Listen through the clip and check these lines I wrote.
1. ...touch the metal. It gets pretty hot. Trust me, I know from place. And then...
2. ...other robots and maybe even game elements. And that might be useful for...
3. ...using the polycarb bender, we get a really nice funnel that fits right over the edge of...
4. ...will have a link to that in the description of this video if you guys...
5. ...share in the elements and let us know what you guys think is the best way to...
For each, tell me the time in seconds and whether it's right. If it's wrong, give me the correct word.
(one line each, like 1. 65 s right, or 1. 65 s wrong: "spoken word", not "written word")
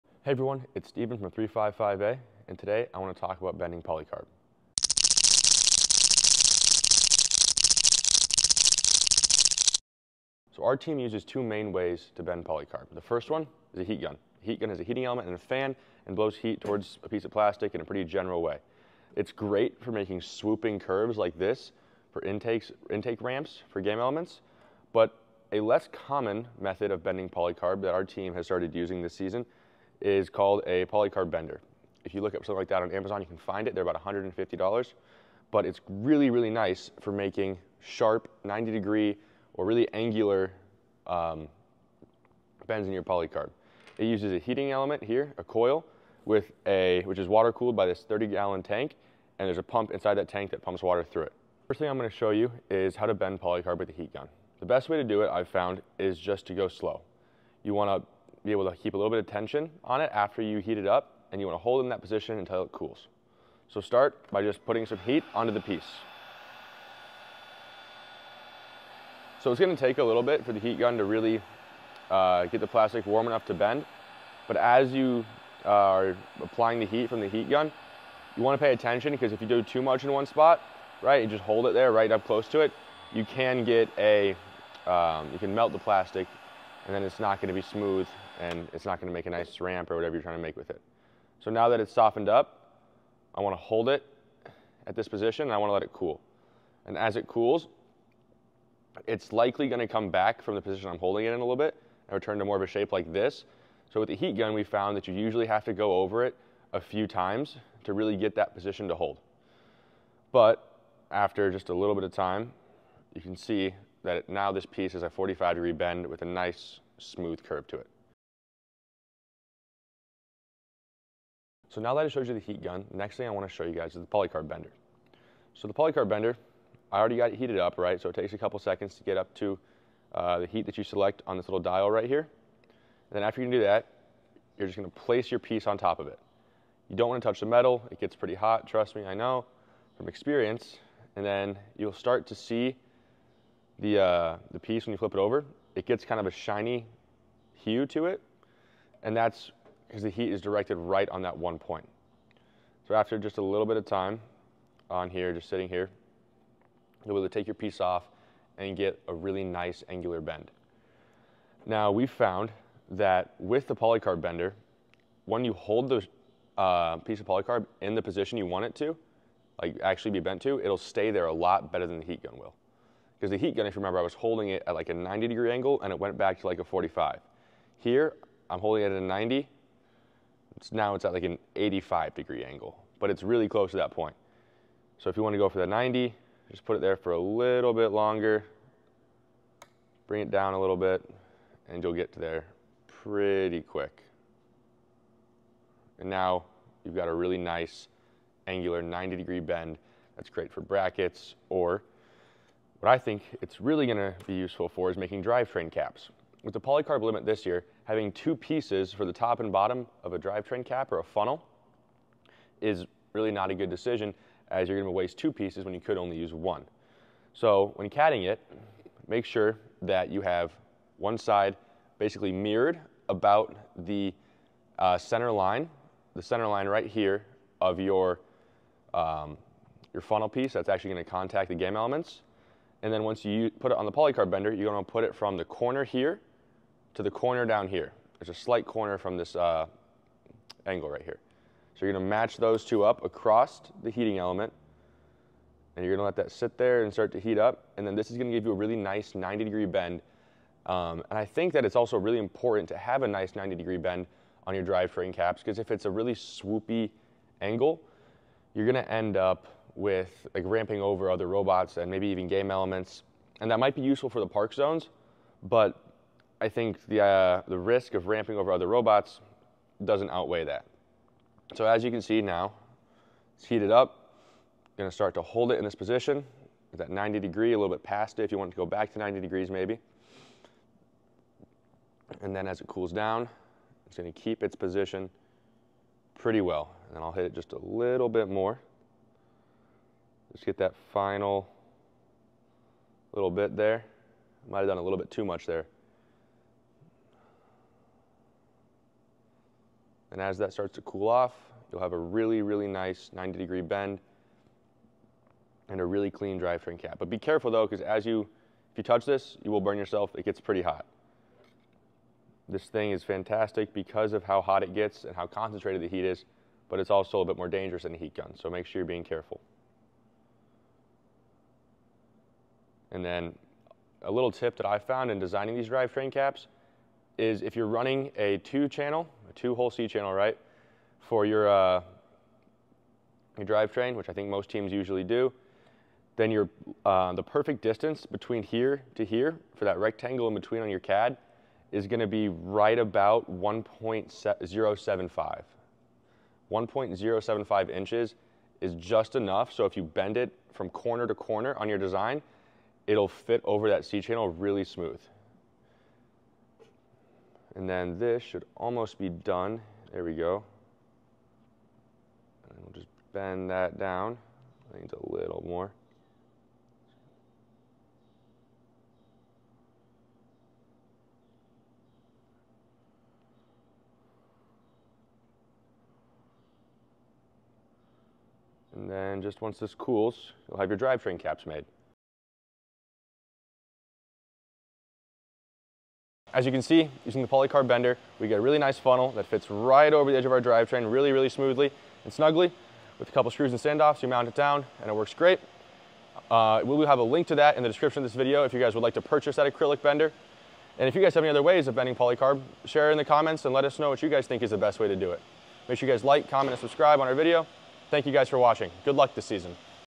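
1. 137 s wrong: "experience", not "place"
2. 261 s right
3. 387 s right
4. 396 s right
5. 402 s wrong: "comments", not "elements".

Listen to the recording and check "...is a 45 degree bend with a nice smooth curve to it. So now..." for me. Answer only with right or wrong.
right.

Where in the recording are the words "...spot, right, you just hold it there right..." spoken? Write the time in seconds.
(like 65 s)
80 s.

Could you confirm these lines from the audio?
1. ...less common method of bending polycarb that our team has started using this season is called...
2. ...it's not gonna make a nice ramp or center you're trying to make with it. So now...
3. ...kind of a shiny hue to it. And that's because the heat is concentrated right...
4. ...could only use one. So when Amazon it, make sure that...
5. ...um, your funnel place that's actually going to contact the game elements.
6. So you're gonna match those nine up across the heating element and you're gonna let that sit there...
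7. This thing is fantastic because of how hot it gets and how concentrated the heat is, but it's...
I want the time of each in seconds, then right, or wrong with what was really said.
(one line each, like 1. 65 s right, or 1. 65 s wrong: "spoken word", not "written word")
1. 25 s right
2. 88 s wrong: "whatever", not "center"
3. 146 s wrong: "directed", not "concentrated"
4. 215 s wrong: "CADing", not "Amazon"
5. 228 s wrong: "piece", not "place"
6. 241 s wrong: "two", not "nine"
7. 312 s right.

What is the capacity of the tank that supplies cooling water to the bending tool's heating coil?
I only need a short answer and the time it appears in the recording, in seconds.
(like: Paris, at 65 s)
30 gallons, at 48 s.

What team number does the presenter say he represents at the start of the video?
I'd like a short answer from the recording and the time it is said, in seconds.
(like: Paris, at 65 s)
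355A, at 1 s.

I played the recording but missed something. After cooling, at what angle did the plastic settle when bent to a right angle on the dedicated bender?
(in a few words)
85 degrees.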